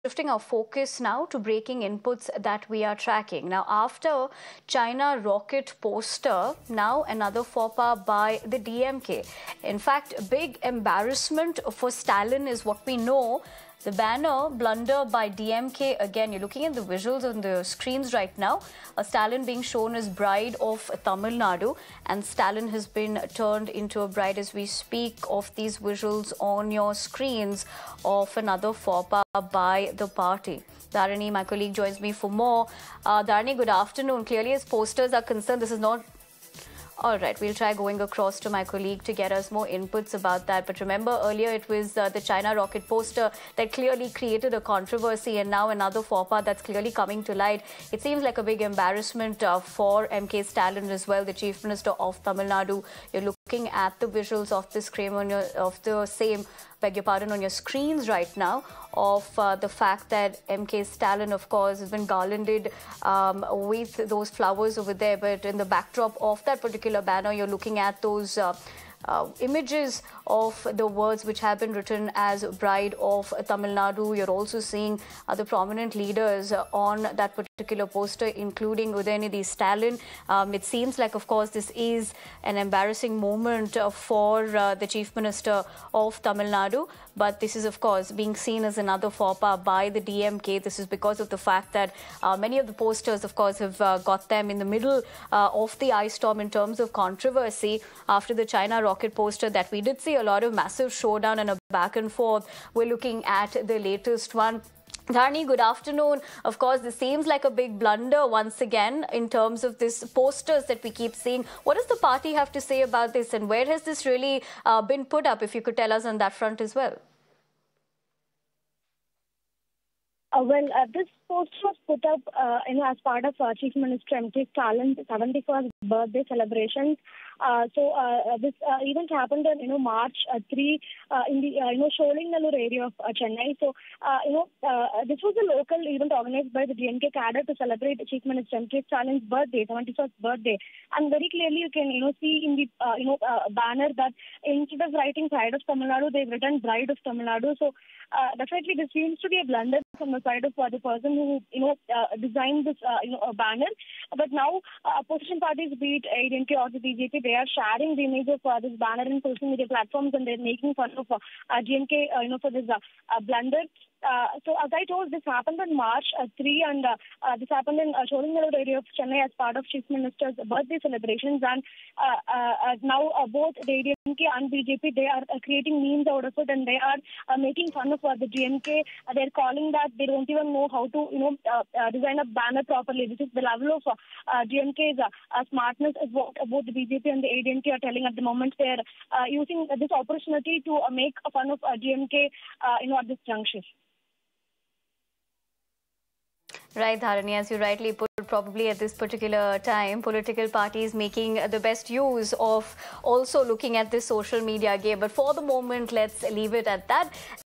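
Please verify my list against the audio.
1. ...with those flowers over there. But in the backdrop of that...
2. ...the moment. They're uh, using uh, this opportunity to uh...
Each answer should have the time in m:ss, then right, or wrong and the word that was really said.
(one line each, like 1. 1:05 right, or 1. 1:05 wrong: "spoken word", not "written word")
1. 1:03 right
2. 3:08 right.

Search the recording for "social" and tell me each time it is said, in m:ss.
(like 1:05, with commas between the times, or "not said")
2:39, 3:24.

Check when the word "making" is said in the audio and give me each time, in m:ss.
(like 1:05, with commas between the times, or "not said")
2:40, 2:57, 3:20.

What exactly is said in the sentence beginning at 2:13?
So, uh, you know, uh, uh this was a local event organized by the DMK cadre to celebrate Chief Minister M.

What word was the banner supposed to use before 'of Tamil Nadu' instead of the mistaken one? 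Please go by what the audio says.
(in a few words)
Pride.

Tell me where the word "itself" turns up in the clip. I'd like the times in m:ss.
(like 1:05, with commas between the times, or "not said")
not said.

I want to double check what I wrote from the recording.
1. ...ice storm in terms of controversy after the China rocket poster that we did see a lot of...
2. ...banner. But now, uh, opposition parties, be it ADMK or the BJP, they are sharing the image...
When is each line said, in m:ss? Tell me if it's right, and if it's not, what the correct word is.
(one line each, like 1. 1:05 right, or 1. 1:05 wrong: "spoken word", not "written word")
1. 1:35 right
2. 2:33 right.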